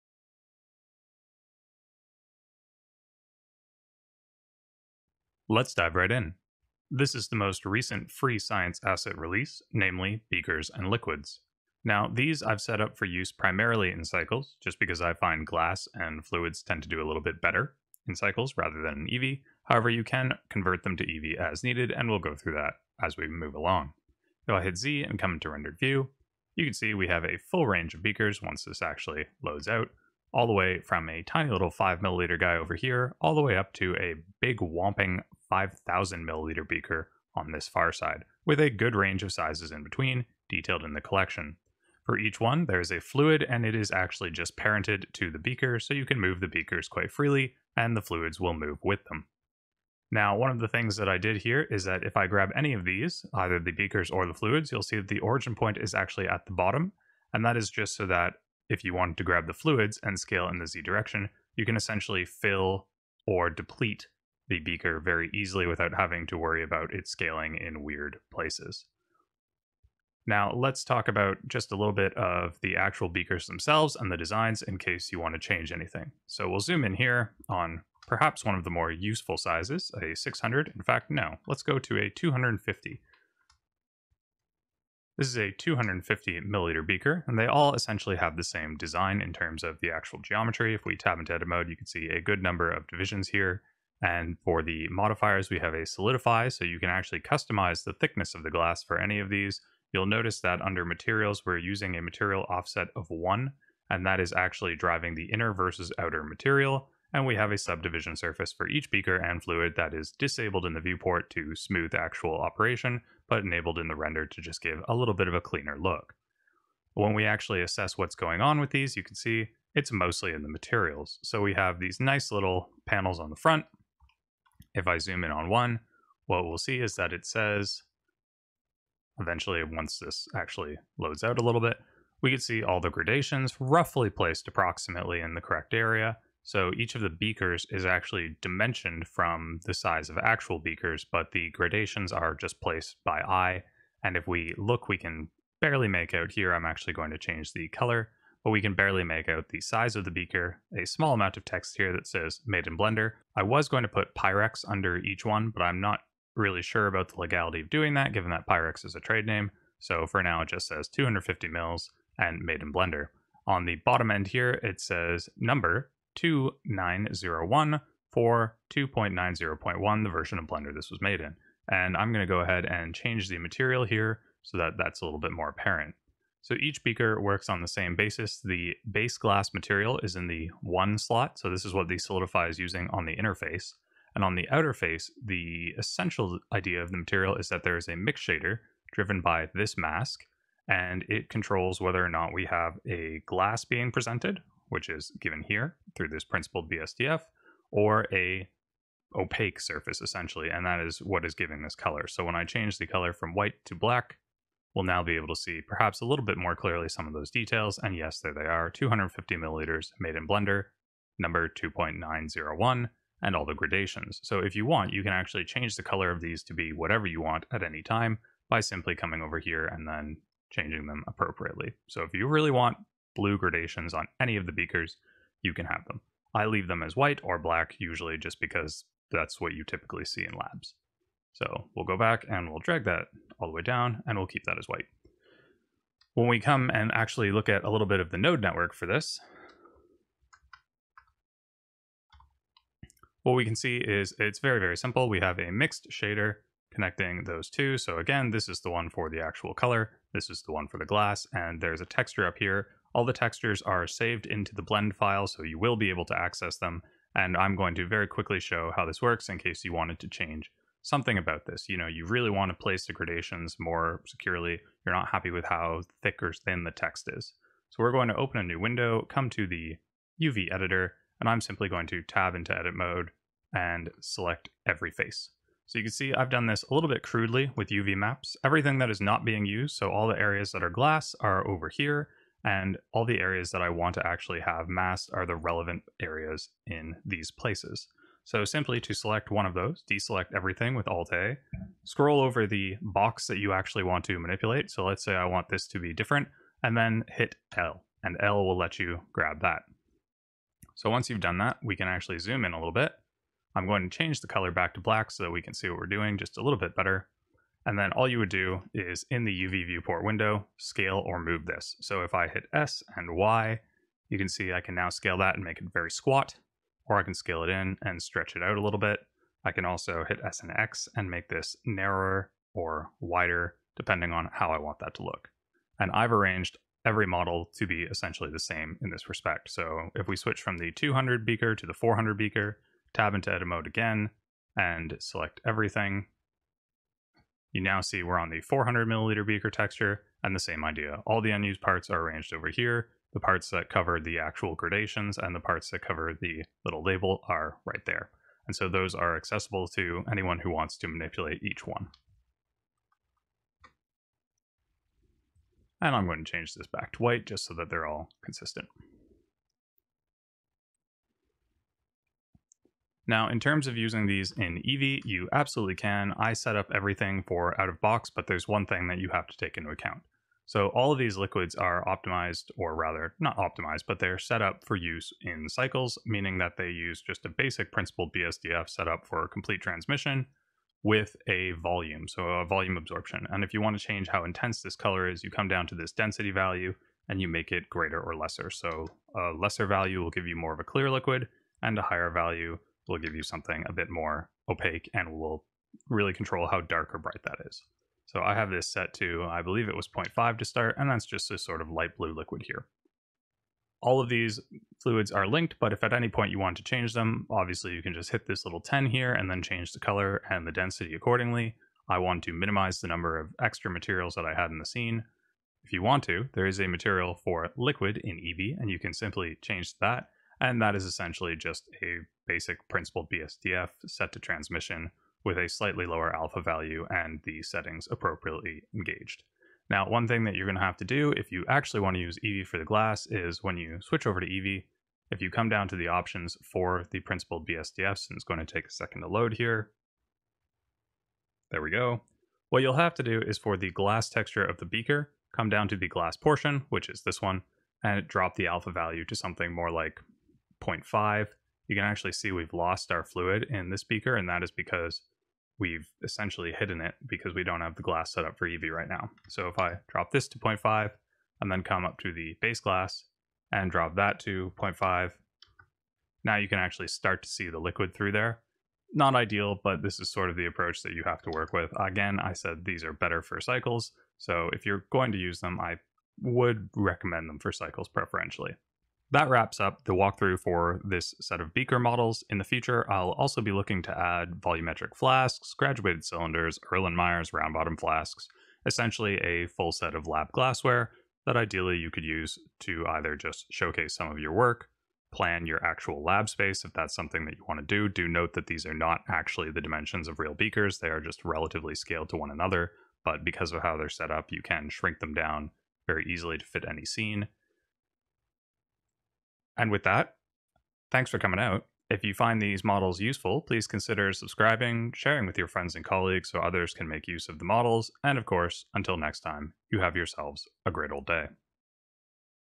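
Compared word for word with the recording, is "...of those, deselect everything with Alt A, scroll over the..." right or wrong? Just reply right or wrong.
right.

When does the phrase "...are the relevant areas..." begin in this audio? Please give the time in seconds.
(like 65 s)
285 s.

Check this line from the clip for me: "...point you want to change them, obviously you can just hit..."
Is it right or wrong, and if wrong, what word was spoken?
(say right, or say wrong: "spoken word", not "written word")
right.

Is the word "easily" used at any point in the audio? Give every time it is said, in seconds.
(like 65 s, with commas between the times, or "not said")
65 s, 506 s.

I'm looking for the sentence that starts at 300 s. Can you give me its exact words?
So once you've done that, we can actually zoom in a little bit.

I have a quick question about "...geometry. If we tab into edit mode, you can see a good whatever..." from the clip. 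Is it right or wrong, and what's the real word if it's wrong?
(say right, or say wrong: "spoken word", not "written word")
wrong: "number", not "whatever".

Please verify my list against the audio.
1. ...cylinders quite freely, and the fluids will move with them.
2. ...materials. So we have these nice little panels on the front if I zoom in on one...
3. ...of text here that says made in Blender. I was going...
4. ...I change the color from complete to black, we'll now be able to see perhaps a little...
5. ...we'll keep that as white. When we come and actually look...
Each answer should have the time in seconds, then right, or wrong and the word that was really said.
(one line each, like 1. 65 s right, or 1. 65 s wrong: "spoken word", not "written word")
1. 46 s wrong: "beakers", not "cylinders"
2. 120 s right
3. 151 s right
4. 202 s wrong: "white", not "complete"
5. 234 s right.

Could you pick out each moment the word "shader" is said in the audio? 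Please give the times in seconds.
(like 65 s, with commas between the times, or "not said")
188 s, 245 s.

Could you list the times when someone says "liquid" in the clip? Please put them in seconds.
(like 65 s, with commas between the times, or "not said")
10 s, 371 s, 390 s, 402 s, 417 s, 467 s.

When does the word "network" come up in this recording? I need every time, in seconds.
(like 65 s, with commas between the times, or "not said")
238 s.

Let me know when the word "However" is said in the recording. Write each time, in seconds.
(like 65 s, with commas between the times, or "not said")
19 s.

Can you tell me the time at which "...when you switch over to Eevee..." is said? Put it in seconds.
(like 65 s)
433 s.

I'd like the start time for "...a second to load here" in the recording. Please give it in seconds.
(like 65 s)
438 s.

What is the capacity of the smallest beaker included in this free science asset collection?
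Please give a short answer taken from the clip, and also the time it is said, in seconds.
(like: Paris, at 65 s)
5 milliliters, at 31 s.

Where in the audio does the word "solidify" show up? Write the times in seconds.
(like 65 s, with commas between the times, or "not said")
95 s, 181 s.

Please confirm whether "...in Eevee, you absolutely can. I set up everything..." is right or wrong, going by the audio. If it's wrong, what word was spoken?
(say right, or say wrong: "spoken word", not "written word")
right.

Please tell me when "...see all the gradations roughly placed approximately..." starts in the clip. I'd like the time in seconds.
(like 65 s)
132 s.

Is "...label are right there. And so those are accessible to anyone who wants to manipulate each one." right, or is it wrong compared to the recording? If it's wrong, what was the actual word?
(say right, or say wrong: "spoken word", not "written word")
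right.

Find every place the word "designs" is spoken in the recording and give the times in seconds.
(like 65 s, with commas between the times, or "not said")
74 s, 88 s.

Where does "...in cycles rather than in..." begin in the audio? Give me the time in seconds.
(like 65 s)
18 s.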